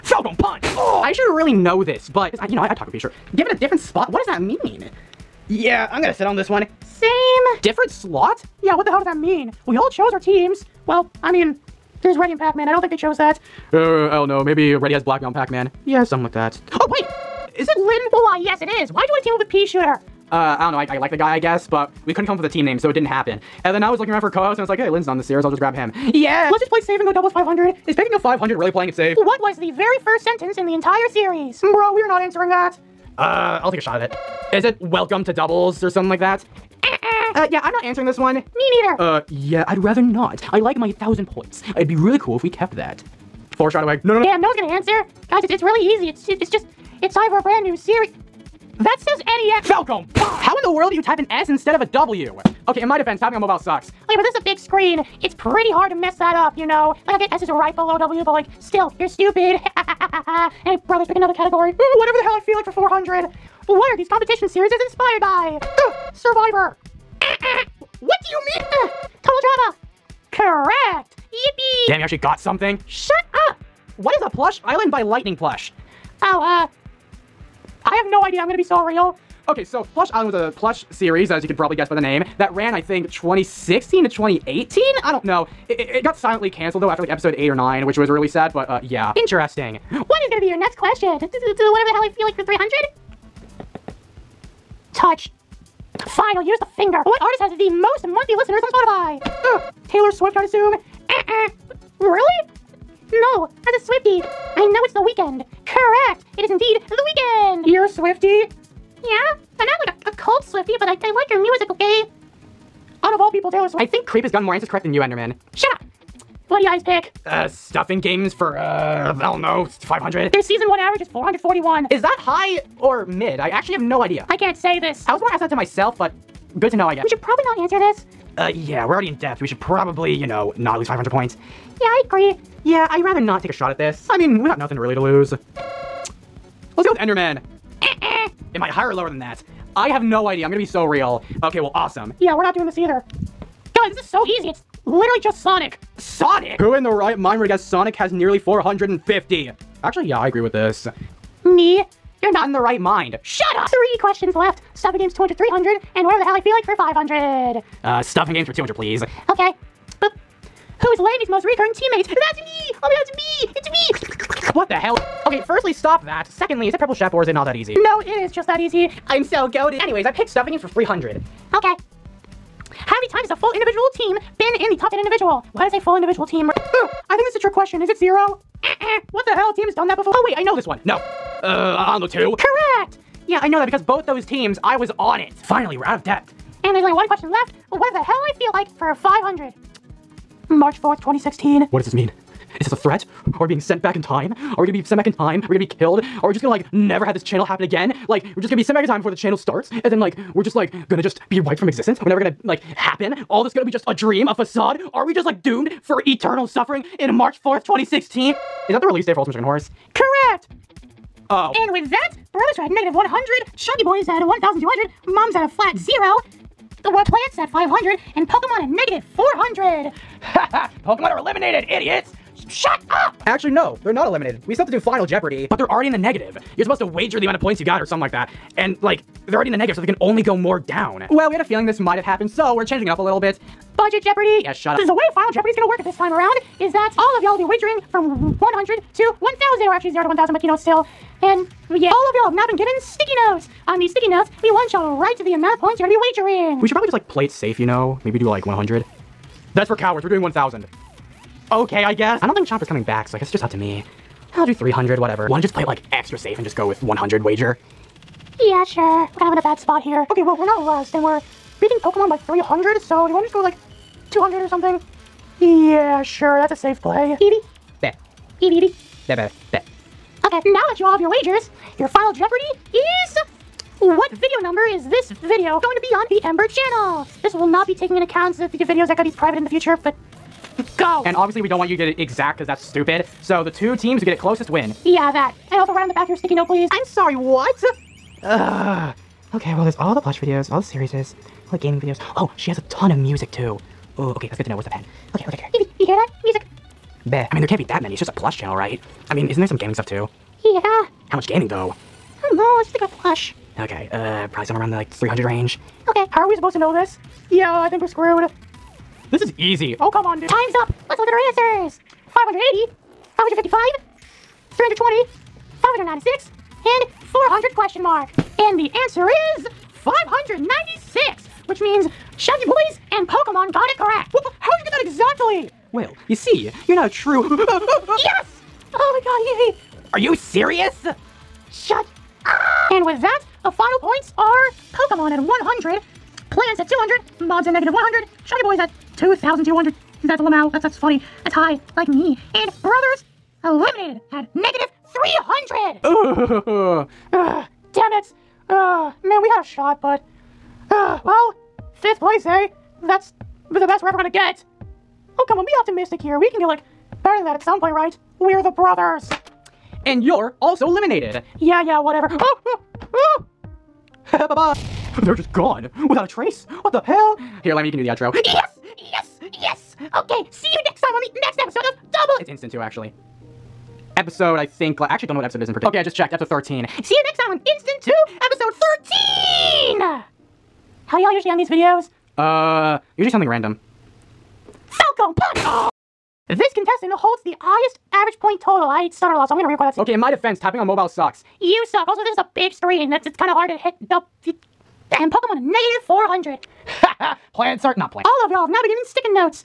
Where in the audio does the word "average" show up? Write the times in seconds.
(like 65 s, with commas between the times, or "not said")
120 s, 387 s.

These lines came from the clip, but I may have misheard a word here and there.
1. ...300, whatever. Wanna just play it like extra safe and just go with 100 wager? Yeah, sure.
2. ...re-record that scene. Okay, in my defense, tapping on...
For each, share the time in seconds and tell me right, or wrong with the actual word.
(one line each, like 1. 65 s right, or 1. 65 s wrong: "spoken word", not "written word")
1. 254 s right
2. 389 s right.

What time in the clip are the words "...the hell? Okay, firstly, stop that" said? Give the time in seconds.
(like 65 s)
164 s.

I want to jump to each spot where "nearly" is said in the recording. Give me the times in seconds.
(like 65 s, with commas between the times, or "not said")
148 s.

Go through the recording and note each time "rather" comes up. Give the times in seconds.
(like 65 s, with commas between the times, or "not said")
39 s, 133 s.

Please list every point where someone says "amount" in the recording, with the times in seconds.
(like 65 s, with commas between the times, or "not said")
227 s, 245 s.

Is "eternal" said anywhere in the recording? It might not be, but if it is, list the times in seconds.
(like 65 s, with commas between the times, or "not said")
206 s.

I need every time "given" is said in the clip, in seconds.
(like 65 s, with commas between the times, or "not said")
3 s, 242 s, 398 s.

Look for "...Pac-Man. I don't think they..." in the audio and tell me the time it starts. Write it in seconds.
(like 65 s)
12 s.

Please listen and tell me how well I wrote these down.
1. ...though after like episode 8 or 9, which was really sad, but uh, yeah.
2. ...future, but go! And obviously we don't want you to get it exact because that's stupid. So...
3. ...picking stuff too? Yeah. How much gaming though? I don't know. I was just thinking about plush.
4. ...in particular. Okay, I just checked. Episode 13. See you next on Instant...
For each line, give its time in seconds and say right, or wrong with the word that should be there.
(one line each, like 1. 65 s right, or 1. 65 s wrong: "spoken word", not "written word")
1. 86 s right
2. 279 s right
3. 299 s wrong: "gaming", not "picking"
4. 375 s right.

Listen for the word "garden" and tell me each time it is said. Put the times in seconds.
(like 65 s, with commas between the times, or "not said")
not said.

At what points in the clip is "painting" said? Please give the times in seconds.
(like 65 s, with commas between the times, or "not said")
not said.